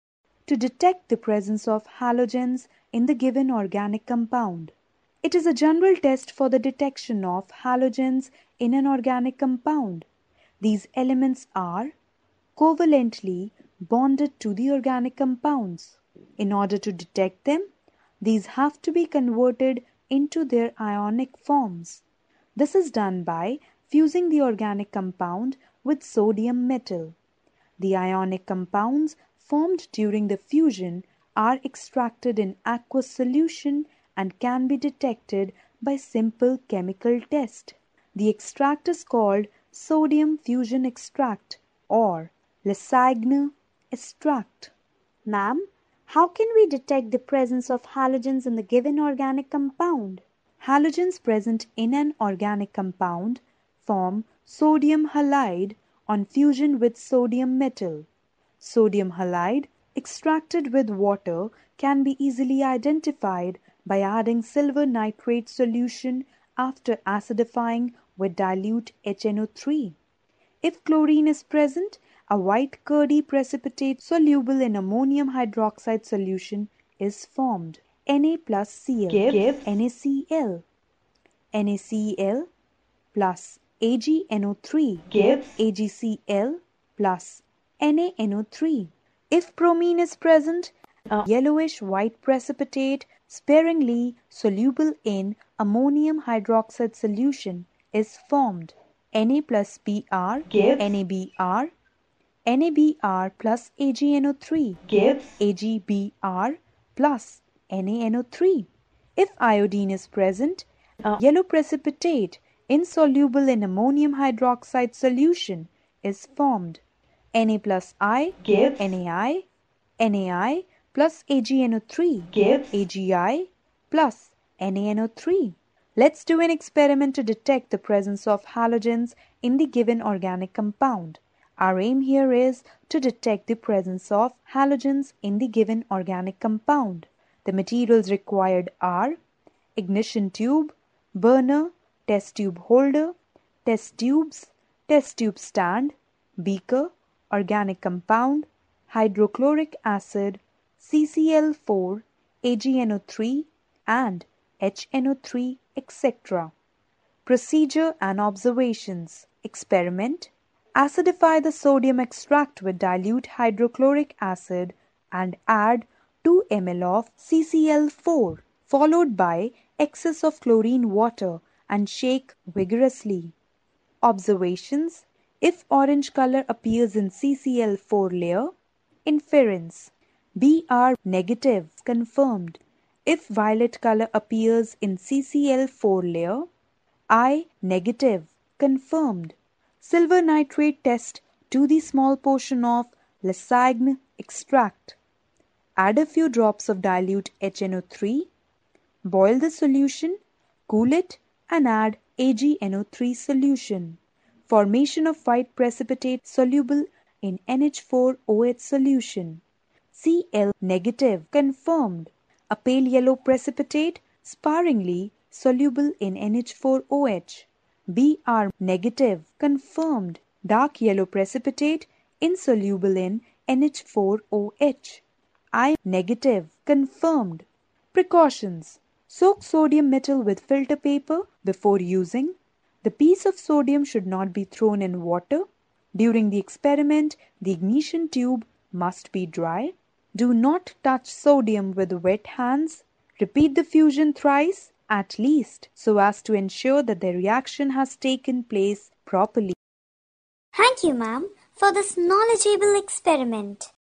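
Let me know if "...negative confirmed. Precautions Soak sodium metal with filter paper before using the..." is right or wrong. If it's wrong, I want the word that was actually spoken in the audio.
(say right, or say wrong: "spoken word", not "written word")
right.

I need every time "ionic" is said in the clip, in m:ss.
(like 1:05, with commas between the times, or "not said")
0:20, 0:27.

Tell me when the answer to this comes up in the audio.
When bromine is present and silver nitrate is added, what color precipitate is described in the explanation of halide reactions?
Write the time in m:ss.
1:31.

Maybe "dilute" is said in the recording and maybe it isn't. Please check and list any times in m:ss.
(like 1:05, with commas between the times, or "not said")
1:08, 2:42, 3:16.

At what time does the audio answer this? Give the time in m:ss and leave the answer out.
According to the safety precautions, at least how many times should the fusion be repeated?
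4:04.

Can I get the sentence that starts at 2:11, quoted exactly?
Our aim here is to detect the presence of halogens in the given organic compound.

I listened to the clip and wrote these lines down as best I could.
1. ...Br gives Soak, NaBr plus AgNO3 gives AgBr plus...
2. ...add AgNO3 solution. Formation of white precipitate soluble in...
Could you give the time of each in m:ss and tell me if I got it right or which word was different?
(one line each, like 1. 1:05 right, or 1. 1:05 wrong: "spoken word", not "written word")
1. 1:39 wrong: "NaBr", not "Soak"
2. 3:21 right.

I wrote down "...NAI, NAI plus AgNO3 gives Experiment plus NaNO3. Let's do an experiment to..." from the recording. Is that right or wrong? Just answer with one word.
wrong.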